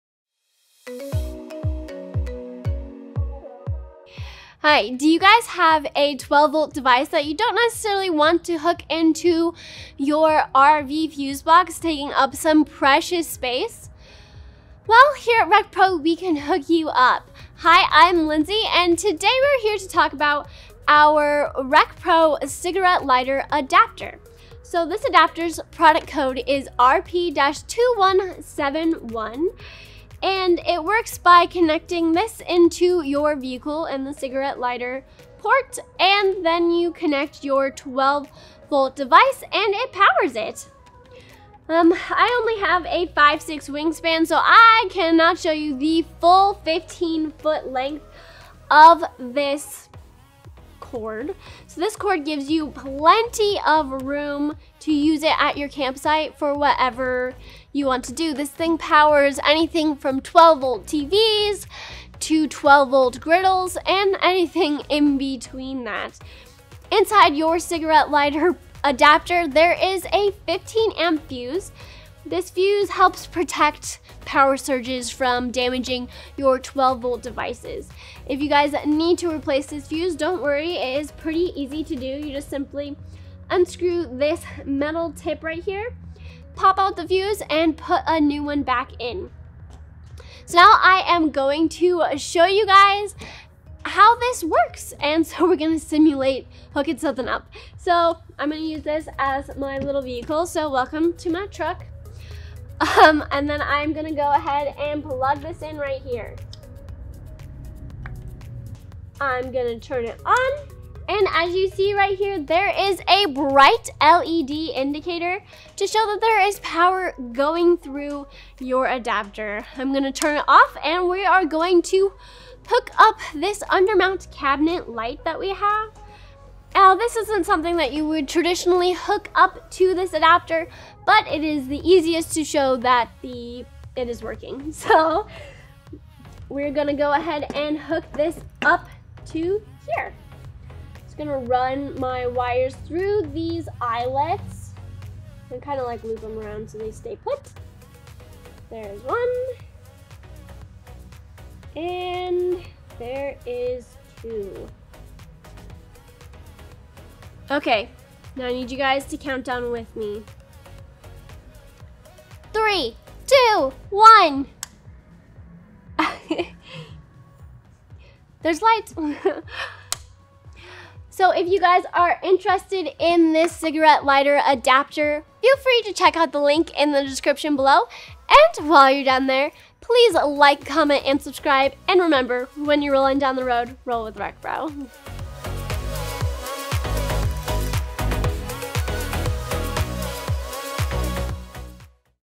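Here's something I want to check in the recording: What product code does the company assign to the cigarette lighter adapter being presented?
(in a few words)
RP-2171.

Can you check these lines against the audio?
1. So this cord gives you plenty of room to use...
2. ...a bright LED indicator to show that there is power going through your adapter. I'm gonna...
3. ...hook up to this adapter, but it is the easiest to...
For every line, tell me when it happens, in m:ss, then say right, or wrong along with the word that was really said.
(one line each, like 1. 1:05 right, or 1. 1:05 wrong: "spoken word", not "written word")
1. 0:51 right
2. 1:53 right
3. 2:08 right.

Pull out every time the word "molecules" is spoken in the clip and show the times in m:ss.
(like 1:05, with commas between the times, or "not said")
not said.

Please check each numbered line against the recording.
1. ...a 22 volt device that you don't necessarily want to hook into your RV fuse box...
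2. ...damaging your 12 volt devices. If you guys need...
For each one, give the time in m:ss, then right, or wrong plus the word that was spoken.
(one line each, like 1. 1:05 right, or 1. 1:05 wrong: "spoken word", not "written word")
1. 0:05 wrong: "12", not "22"
2. 1:15 right.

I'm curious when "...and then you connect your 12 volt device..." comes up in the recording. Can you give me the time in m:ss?
0:35.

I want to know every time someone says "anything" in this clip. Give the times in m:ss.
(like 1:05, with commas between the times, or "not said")
0:59, 1:04.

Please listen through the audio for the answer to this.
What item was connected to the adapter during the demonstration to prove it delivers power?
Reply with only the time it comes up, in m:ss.
2:03.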